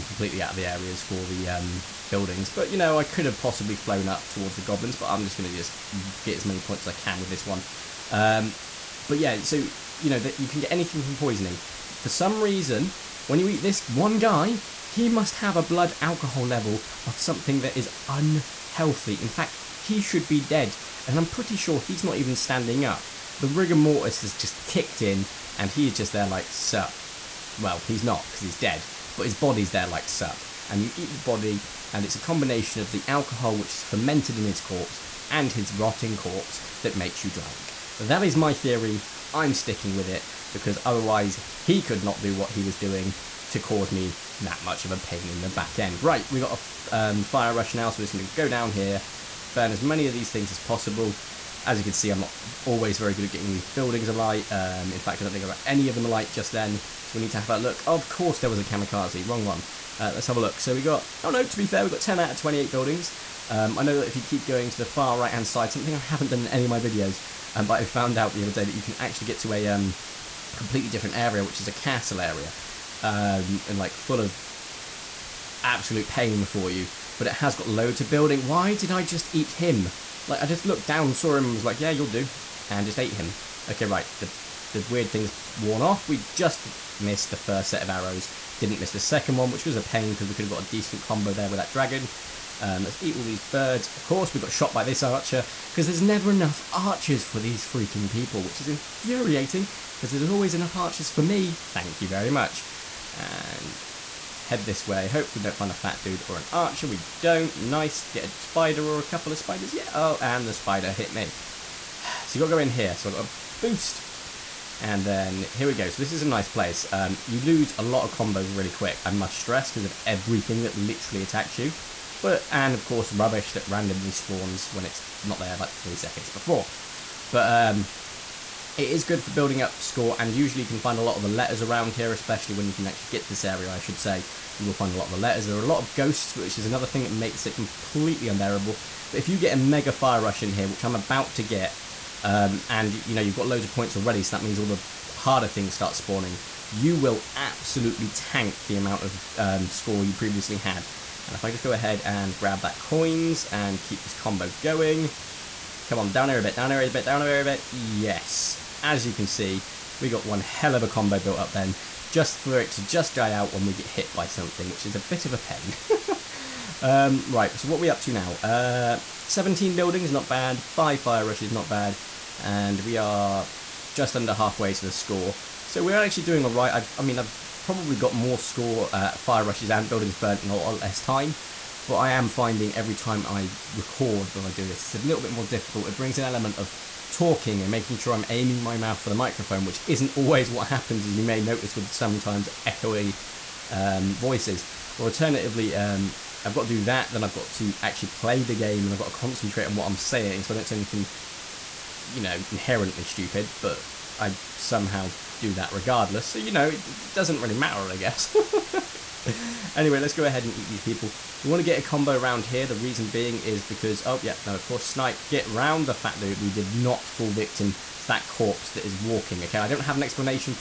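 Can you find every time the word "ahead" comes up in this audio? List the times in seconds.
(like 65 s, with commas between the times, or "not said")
151 s, 210 s.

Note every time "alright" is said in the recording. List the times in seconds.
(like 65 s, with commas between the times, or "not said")
176 s.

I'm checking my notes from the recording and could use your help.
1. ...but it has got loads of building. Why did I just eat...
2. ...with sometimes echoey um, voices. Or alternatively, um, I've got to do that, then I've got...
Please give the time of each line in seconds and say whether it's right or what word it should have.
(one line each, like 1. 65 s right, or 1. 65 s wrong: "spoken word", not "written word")
1. 77 s right
2. 191 s right.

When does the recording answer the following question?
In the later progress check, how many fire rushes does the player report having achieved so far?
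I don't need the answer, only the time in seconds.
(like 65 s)
170 s.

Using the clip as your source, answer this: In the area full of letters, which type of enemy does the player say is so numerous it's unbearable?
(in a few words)
ghosts.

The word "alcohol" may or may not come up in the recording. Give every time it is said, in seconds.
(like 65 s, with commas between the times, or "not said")
16 s, 33 s.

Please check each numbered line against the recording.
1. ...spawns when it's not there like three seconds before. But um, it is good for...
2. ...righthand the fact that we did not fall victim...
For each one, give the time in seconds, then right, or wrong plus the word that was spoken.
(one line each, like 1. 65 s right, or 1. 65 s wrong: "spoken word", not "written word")
1. 124 s right
2. 215 s wrong: "round", not "righthand".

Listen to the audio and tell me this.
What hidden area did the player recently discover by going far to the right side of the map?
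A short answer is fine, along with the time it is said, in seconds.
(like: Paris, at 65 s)
a castle area, at 71 s.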